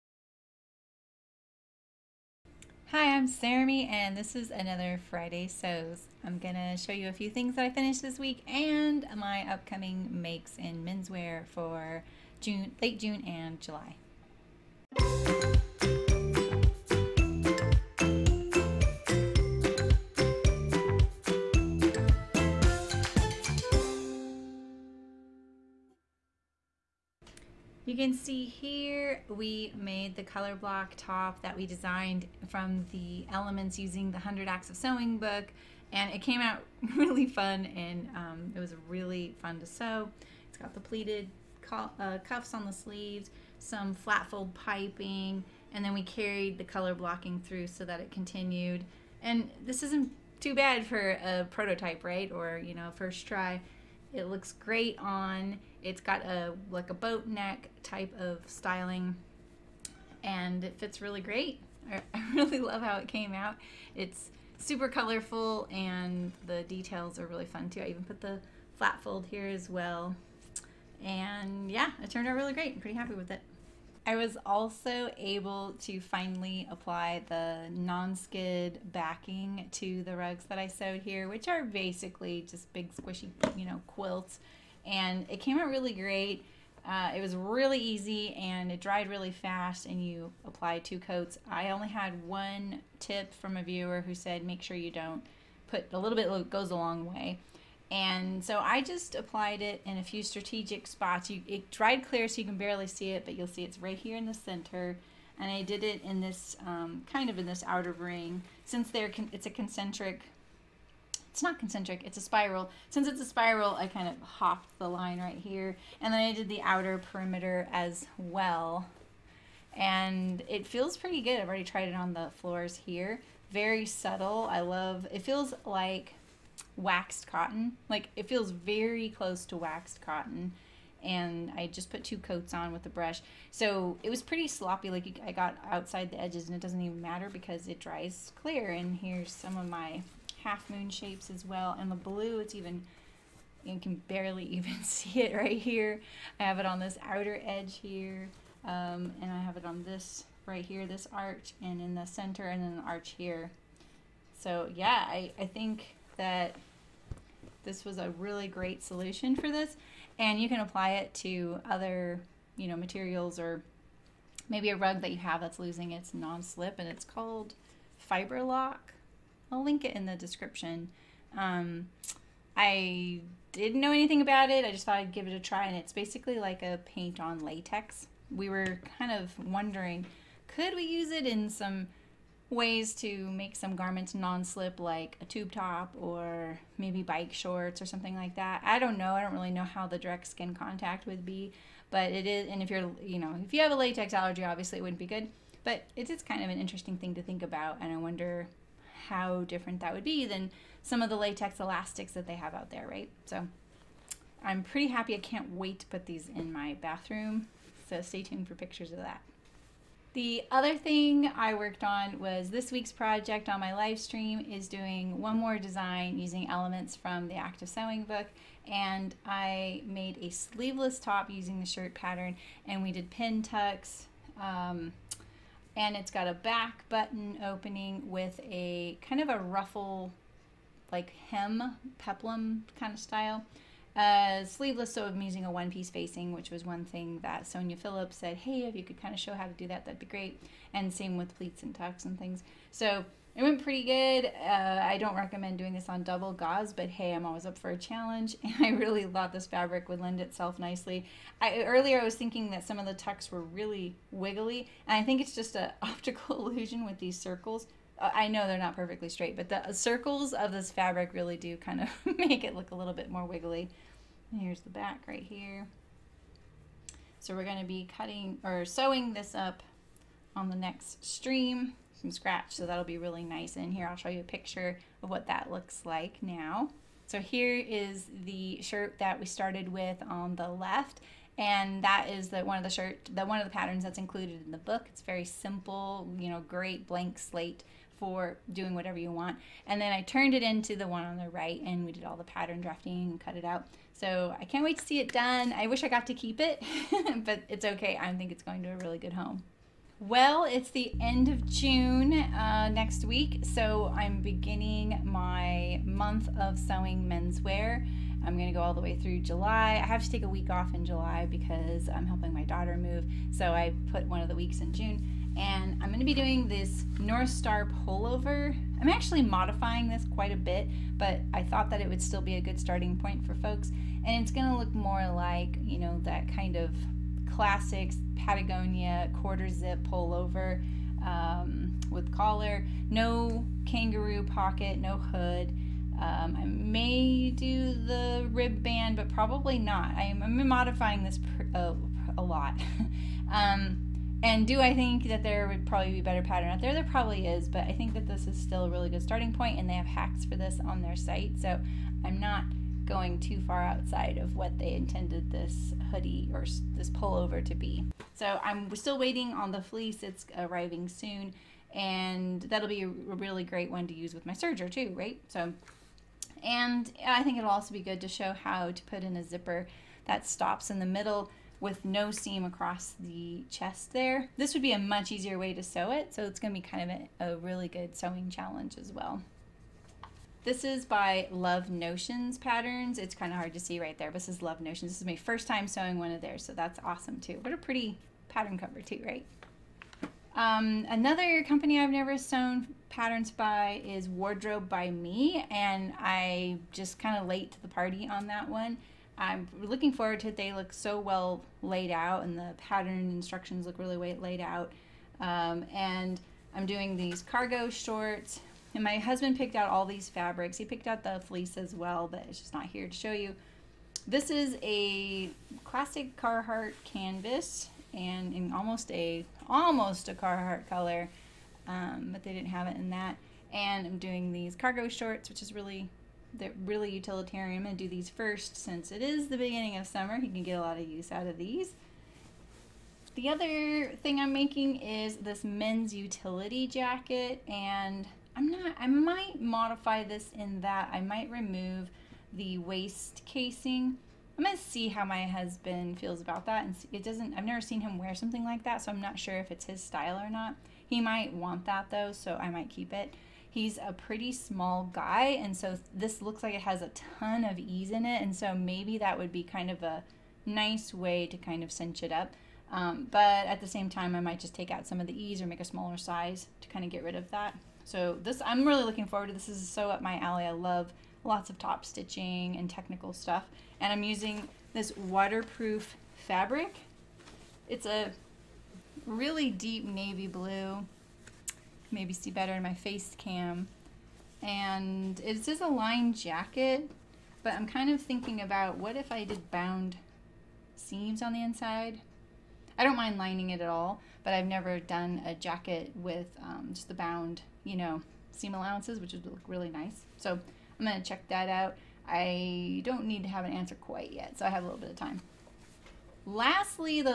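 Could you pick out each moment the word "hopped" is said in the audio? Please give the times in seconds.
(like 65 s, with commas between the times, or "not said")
114 s.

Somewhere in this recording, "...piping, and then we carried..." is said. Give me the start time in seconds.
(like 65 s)
44 s.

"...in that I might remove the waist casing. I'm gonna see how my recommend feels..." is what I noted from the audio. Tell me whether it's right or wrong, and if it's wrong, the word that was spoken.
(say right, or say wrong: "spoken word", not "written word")
wrong: "husband", not "recommend".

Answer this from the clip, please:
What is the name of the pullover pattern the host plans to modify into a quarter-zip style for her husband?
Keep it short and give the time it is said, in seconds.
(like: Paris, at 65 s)
North Star, at 316 s.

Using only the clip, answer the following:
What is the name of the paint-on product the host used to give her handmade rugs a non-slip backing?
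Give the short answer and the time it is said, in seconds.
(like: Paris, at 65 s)
Fiber Lock, at 167 s.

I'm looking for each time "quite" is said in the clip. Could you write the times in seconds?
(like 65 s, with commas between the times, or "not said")
320 s, 503 s.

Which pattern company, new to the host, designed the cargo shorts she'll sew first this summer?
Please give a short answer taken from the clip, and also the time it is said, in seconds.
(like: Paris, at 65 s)
Wardrobe by Me, at 394 s.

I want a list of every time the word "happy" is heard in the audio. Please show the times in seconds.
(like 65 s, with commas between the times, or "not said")
72 s, 204 s.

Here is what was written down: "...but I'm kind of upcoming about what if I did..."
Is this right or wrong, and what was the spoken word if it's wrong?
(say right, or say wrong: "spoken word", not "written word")
wrong: "thinking", not "upcoming".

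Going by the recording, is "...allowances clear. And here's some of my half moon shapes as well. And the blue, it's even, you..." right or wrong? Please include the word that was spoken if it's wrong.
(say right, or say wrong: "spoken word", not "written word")
wrong: "dries", not "allowances".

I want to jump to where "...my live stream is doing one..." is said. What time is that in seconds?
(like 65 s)
213 s.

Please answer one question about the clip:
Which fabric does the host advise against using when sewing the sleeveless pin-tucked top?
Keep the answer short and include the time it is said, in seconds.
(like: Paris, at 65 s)
Double gauze, at 246 s.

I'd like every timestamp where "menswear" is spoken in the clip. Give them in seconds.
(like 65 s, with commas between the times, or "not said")
10 s, 307 s.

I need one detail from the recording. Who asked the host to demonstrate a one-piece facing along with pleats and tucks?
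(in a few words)
Sonya Phillips.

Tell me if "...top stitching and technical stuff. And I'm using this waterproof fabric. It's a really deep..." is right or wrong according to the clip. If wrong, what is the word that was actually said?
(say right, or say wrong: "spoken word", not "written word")
right.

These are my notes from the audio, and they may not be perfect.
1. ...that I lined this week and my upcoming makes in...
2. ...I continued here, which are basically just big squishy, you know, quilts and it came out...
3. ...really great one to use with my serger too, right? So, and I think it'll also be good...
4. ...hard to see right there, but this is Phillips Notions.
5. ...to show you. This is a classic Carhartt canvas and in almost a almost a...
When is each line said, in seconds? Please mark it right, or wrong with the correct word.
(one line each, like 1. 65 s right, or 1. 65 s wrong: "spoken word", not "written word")
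1. 7 s wrong: "finished", not "lined"
2. 80 s wrong: "sewed", not "continued"
3. 362 s right
4. 383 s wrong: "Love", not "Phillips"
5. 412 s right.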